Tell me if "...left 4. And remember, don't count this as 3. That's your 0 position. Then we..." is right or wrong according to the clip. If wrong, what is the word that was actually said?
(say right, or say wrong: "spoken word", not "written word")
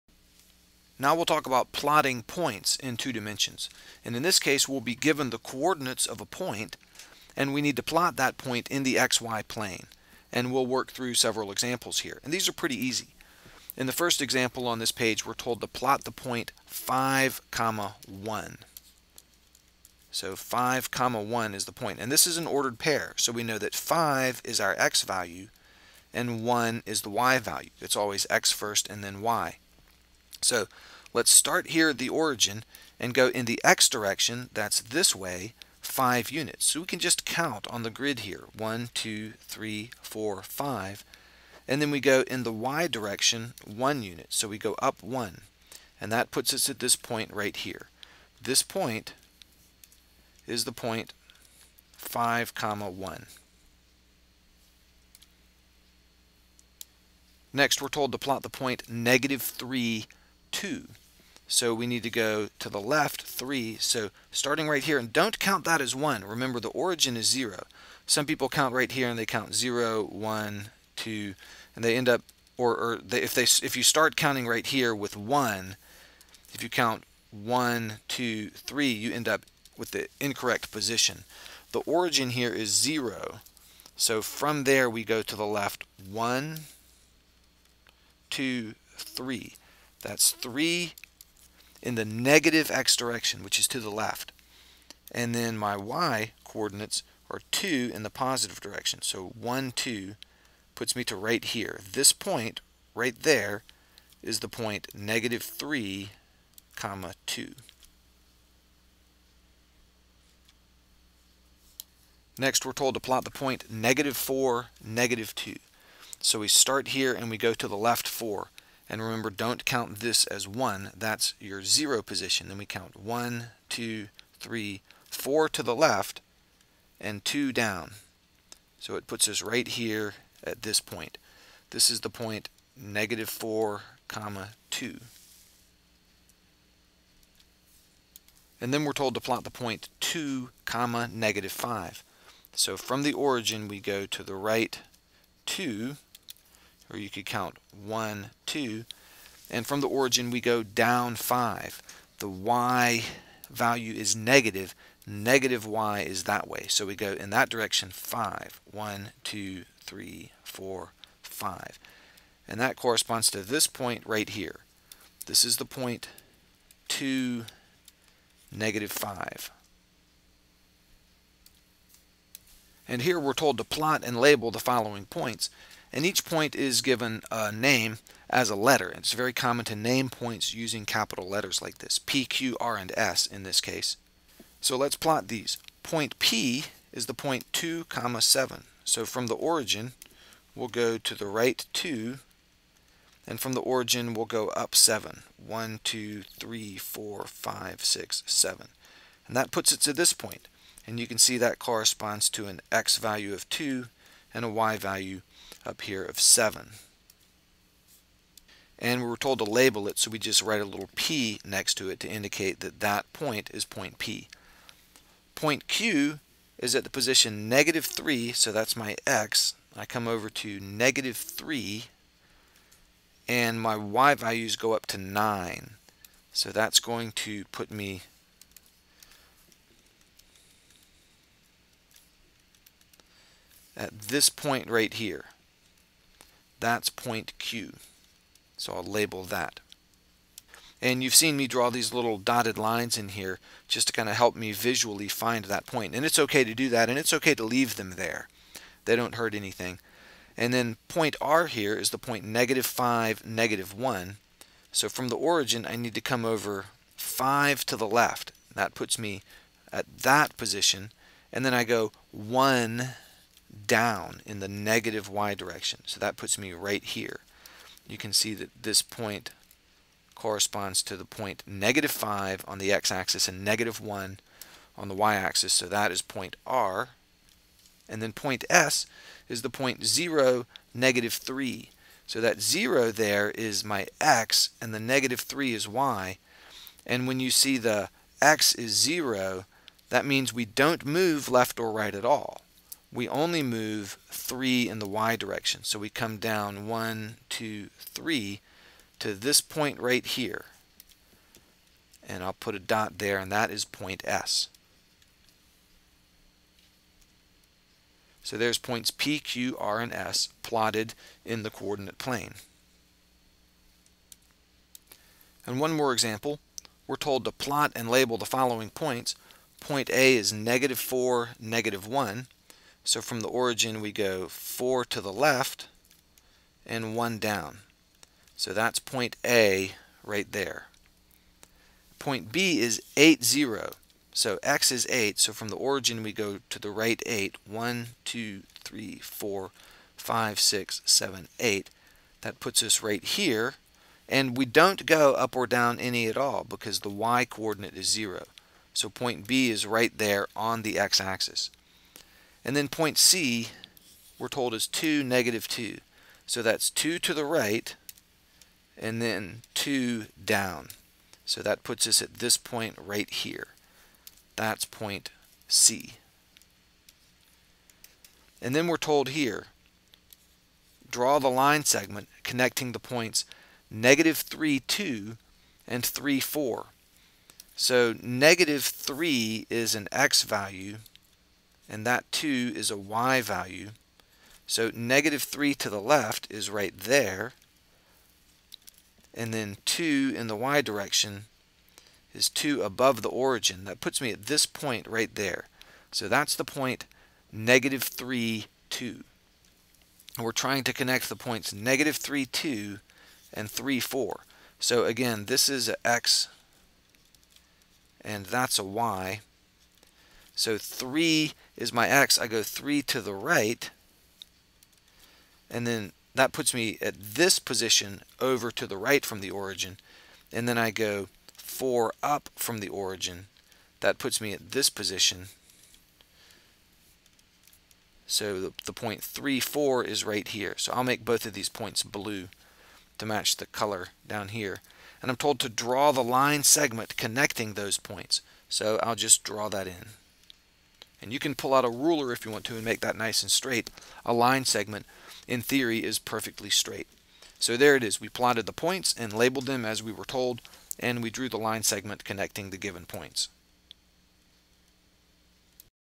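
wrong: "1", not "3".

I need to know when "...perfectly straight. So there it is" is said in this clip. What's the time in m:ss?
7:25.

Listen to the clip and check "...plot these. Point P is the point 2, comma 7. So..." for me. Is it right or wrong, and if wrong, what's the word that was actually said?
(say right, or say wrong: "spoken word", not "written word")
right.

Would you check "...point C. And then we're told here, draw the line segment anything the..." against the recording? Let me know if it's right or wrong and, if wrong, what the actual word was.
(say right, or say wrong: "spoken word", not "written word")
wrong: "connecting", not "anything".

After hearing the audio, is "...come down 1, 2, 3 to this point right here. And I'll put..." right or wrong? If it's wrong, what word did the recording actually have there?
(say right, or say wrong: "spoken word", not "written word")
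right.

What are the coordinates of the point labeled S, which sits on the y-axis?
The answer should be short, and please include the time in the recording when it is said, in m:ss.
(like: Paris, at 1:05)
0, -3, at 4:39.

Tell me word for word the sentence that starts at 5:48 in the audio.
So point B is right there on the x-axis.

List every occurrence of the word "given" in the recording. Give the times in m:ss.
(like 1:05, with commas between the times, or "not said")
0:04, 2:56, 7:32.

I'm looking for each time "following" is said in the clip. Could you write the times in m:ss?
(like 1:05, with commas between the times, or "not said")
2:54, 5:18.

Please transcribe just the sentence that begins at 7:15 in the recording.
And I'm told to draw the line segment connecting those points.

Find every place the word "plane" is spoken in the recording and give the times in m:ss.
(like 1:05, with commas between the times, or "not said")
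0:09, 5:11.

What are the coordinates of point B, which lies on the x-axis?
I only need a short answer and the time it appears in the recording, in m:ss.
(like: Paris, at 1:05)
8, 0, at 5:32.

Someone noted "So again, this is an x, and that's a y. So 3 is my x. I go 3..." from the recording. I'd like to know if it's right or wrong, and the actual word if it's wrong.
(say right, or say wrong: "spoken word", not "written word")
right.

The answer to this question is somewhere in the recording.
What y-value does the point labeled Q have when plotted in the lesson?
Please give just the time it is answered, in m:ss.
3:44.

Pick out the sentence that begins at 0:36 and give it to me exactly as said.
So we can just count on the grid here, 1, 2, 3, 4, 5.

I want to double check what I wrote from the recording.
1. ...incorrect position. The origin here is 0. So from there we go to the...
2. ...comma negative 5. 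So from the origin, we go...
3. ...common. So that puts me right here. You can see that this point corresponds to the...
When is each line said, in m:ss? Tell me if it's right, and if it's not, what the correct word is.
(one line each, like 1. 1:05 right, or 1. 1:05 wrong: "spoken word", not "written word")
1. 1:20 right
2. 2:20 right
3. 4:25 wrong: "direction", not "common".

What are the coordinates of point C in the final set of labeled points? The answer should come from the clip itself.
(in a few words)
2, -2.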